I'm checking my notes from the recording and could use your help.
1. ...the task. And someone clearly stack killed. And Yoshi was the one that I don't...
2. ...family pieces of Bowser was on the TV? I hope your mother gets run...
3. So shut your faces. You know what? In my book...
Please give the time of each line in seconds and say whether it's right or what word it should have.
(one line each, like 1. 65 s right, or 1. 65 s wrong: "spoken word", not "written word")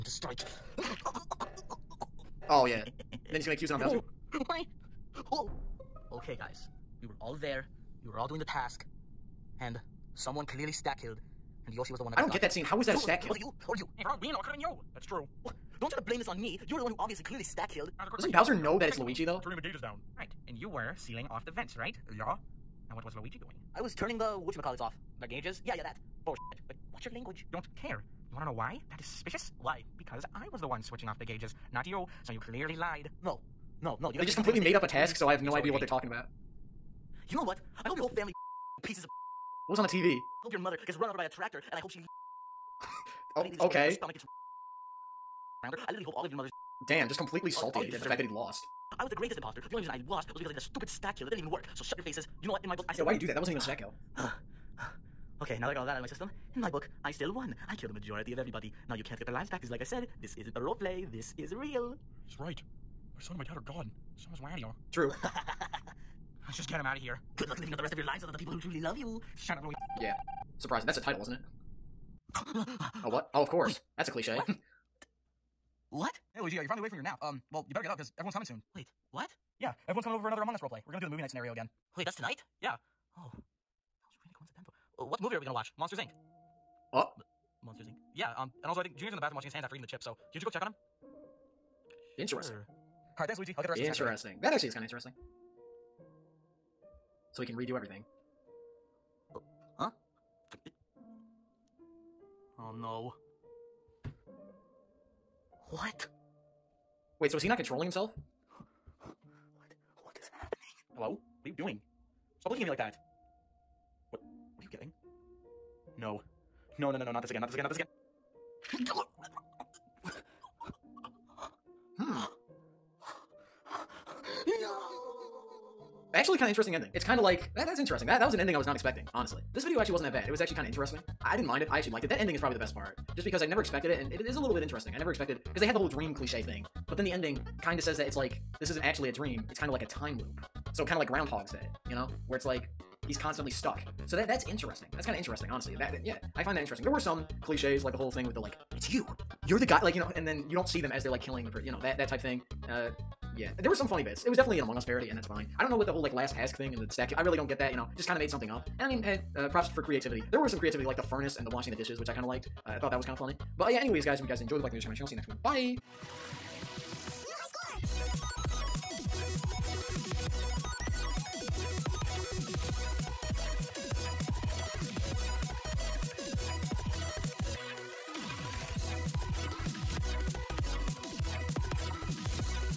1. 8 s right
2. 38 s wrong: "What", not "Bowser"
3. 51 s right.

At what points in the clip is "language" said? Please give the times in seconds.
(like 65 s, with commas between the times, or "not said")
27 s.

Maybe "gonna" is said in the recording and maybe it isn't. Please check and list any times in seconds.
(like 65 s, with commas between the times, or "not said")
3 s, 80 s, 85 s.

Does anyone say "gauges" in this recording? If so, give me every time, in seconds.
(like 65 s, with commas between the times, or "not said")
19 s, 25 s, 31 s.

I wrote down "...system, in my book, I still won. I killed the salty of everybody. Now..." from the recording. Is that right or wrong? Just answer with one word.
wrong.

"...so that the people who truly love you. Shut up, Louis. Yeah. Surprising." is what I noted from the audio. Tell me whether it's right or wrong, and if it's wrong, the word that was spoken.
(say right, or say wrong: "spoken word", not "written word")
right.